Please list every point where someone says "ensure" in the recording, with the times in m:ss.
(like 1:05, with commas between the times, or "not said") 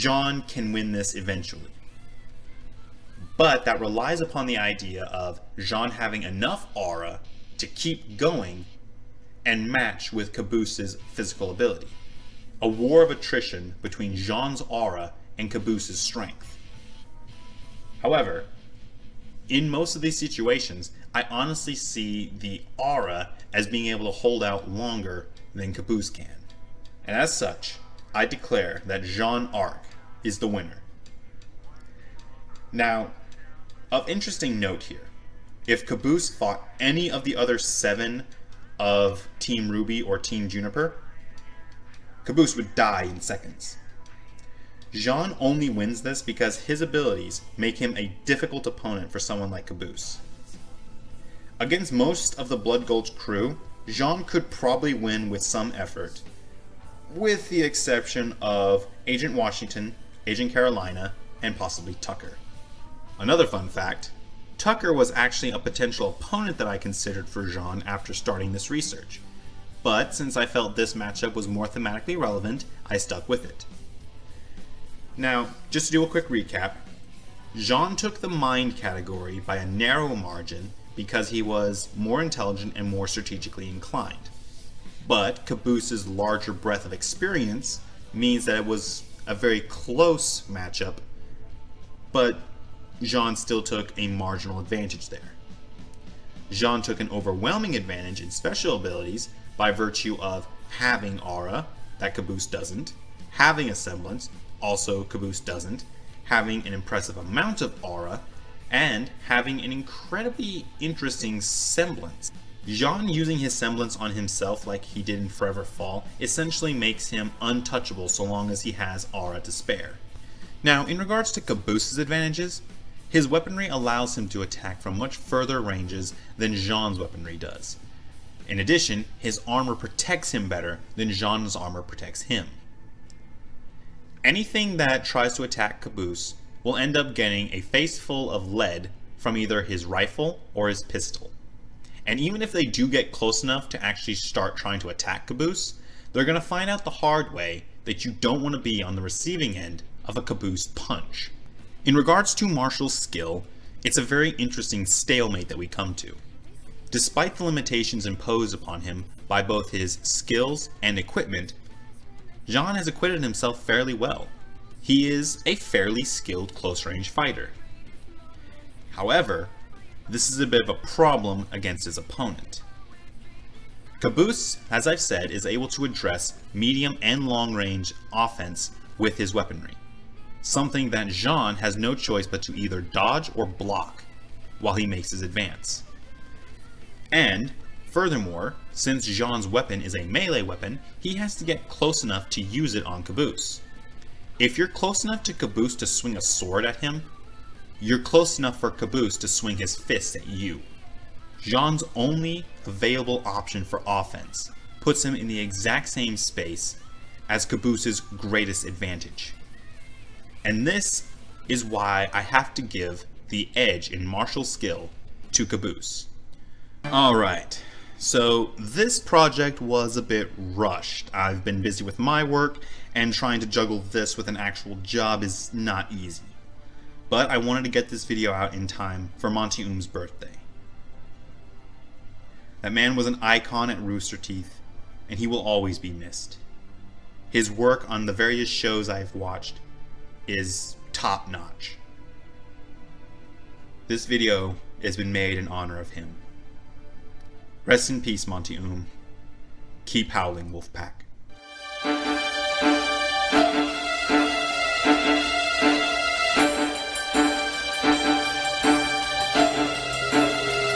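not said.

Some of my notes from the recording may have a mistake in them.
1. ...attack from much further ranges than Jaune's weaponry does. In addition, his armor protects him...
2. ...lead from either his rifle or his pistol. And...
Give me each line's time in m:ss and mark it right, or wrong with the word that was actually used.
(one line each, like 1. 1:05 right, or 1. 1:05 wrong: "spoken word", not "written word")
1. 2:04 right
2. 2:18 right.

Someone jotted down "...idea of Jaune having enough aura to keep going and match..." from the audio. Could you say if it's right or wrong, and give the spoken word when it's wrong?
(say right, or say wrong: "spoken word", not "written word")
right.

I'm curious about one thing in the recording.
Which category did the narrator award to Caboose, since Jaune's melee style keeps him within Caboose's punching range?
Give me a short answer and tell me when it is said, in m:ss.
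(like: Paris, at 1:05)
Martial skill, at 3:34.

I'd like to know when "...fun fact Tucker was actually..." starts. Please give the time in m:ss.
1:03.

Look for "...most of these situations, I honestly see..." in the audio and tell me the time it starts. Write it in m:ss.
0:19.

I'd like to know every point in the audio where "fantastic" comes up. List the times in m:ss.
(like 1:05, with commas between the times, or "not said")
not said.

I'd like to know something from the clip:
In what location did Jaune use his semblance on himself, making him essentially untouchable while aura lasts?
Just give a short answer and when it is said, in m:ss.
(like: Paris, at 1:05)
Forever Fall, at 1:55.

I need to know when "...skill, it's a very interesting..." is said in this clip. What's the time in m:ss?
2:32.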